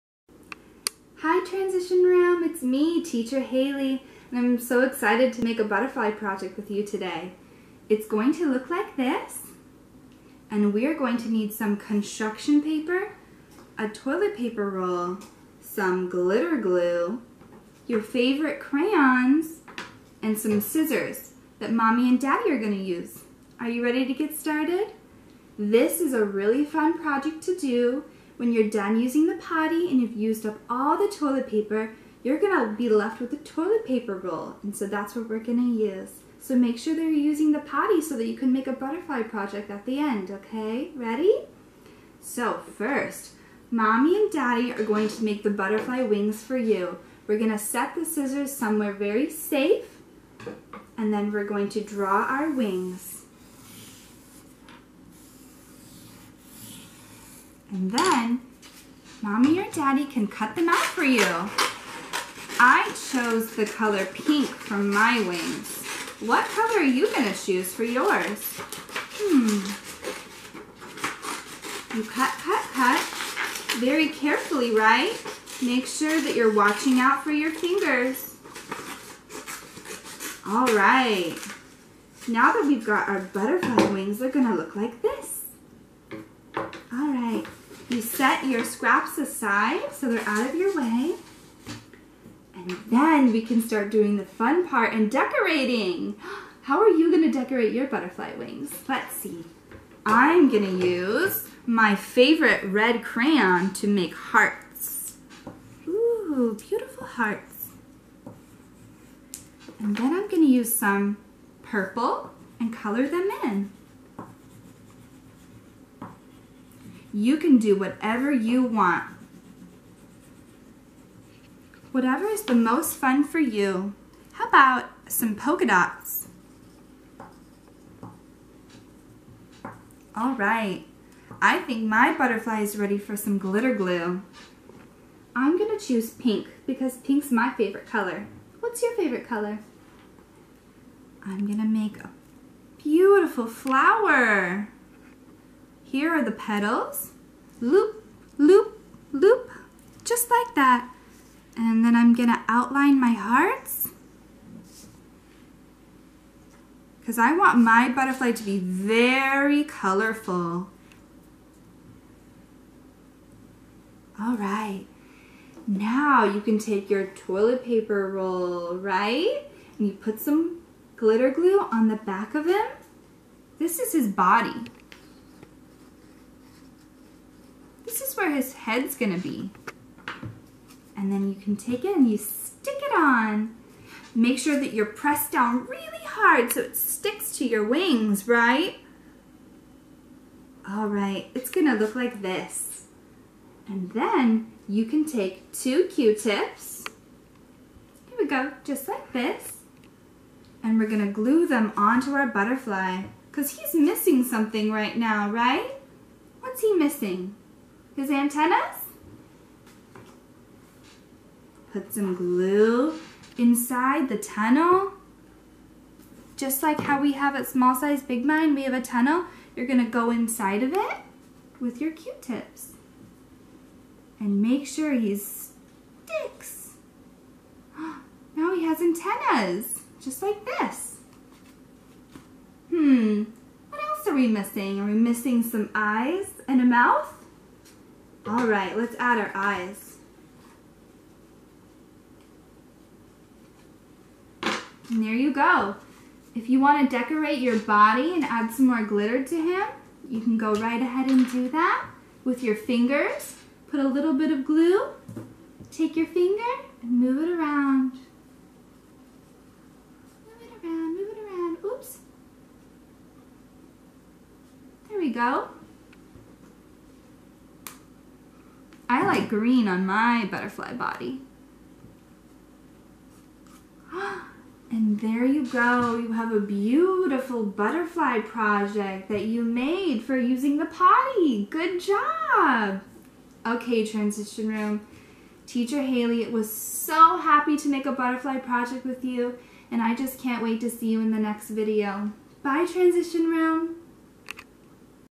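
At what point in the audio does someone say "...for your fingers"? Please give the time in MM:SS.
01:17.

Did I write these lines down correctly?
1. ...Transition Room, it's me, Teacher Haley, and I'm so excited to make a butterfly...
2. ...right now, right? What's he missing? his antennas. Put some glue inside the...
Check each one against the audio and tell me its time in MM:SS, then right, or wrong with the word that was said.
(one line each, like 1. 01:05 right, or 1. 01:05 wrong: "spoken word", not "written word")
1. 00:01 right
2. 03:24 right.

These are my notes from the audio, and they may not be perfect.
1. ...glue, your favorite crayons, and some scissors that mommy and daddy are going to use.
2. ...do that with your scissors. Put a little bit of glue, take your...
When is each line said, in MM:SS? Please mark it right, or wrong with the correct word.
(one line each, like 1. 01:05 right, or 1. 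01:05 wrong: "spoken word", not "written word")
1. 00:16 right
2. 04:11 wrong: "fingers", not "scissors".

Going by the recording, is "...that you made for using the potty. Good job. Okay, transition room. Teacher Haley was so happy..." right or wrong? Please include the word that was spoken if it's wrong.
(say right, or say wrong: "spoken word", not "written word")
right.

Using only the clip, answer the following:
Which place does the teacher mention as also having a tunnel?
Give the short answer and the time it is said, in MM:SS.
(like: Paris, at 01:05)
Small Size Big Mind, at 03:37.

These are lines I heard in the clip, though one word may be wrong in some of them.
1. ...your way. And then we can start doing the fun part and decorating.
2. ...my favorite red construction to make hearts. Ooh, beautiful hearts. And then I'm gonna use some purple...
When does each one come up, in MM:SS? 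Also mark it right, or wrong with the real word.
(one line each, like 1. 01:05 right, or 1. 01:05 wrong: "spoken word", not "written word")
1. 01:30 right
2. 01:41 wrong: "crayon", not "construction".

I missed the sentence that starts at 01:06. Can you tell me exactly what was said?
What color are you going to choose for yours?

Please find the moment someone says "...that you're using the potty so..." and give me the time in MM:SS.
00:36.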